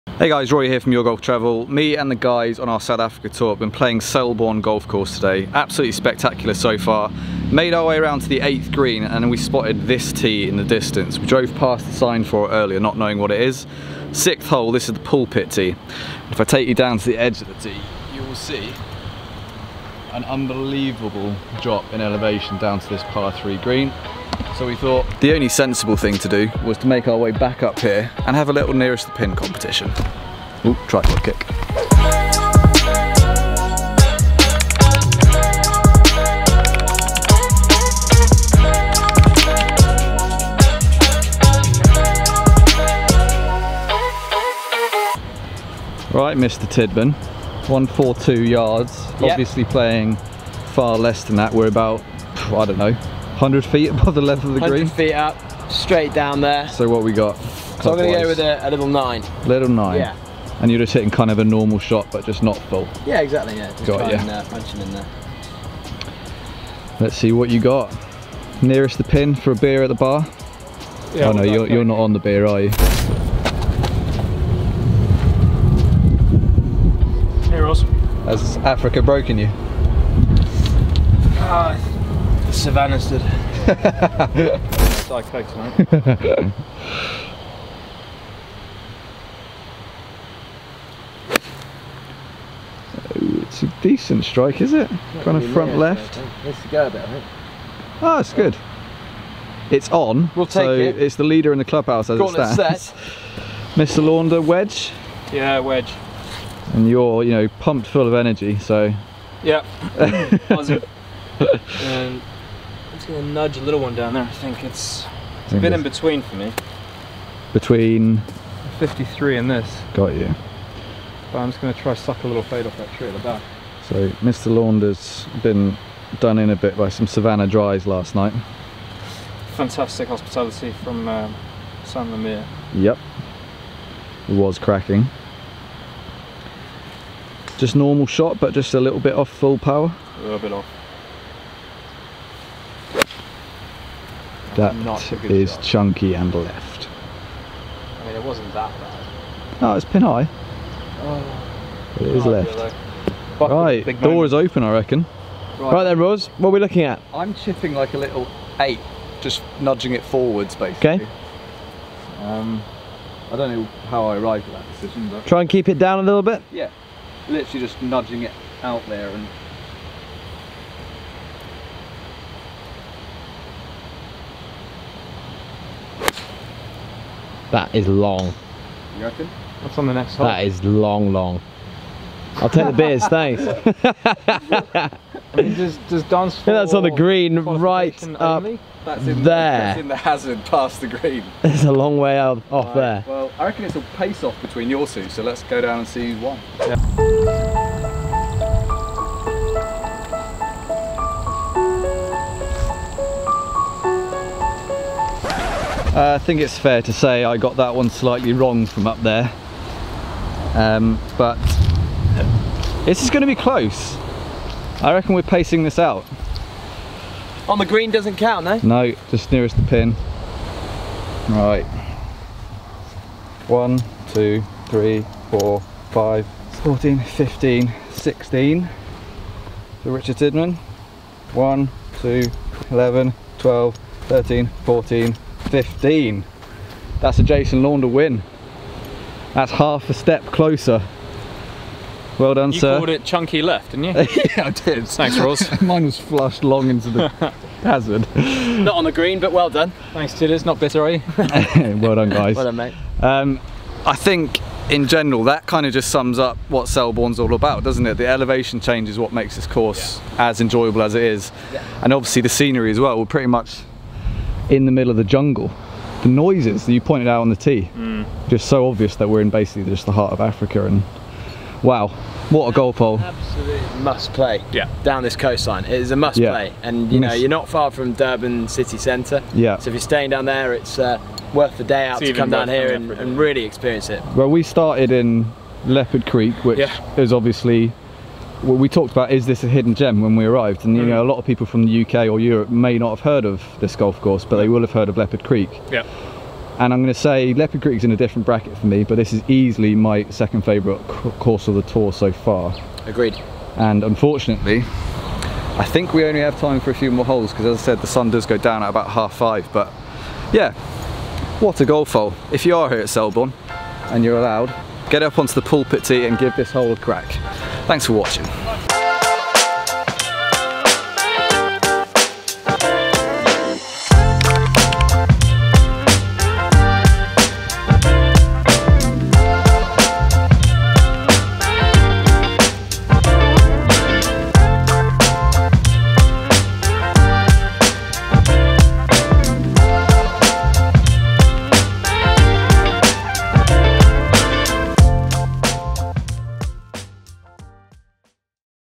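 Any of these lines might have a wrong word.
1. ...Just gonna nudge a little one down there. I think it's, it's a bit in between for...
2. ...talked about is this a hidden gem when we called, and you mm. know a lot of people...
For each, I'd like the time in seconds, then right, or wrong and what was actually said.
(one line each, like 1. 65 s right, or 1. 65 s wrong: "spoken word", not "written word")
1. 113 s right
2. 288 s wrong: "arrived", not "called".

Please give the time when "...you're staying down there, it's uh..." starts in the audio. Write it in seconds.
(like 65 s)
279 s.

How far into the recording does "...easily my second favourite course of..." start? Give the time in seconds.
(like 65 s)
299 s.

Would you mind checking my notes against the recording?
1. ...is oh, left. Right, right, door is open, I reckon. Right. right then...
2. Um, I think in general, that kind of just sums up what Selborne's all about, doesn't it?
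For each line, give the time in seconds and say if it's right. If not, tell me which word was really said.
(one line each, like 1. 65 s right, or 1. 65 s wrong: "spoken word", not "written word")
1. 152 s right
2. 253 s right.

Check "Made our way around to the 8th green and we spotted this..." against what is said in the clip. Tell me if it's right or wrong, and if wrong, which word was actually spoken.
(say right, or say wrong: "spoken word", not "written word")
right.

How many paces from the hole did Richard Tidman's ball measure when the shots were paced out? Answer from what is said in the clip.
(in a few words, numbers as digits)
16.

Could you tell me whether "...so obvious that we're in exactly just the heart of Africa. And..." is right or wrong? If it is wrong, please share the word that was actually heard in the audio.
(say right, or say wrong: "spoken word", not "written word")
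wrong: "basically", not "exactly".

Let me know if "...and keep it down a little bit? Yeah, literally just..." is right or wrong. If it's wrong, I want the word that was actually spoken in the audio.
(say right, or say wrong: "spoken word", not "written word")
right.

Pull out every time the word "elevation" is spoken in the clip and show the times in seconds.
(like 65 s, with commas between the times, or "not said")
21 s, 258 s.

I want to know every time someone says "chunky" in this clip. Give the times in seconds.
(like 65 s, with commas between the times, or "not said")
145 s, 243 s.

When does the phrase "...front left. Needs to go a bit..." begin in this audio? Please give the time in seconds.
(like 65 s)
95 s.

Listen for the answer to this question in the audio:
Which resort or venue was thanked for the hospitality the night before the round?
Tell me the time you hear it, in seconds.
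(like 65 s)
131 s.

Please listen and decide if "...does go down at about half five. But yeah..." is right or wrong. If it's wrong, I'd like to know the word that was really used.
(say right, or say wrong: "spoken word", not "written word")
right.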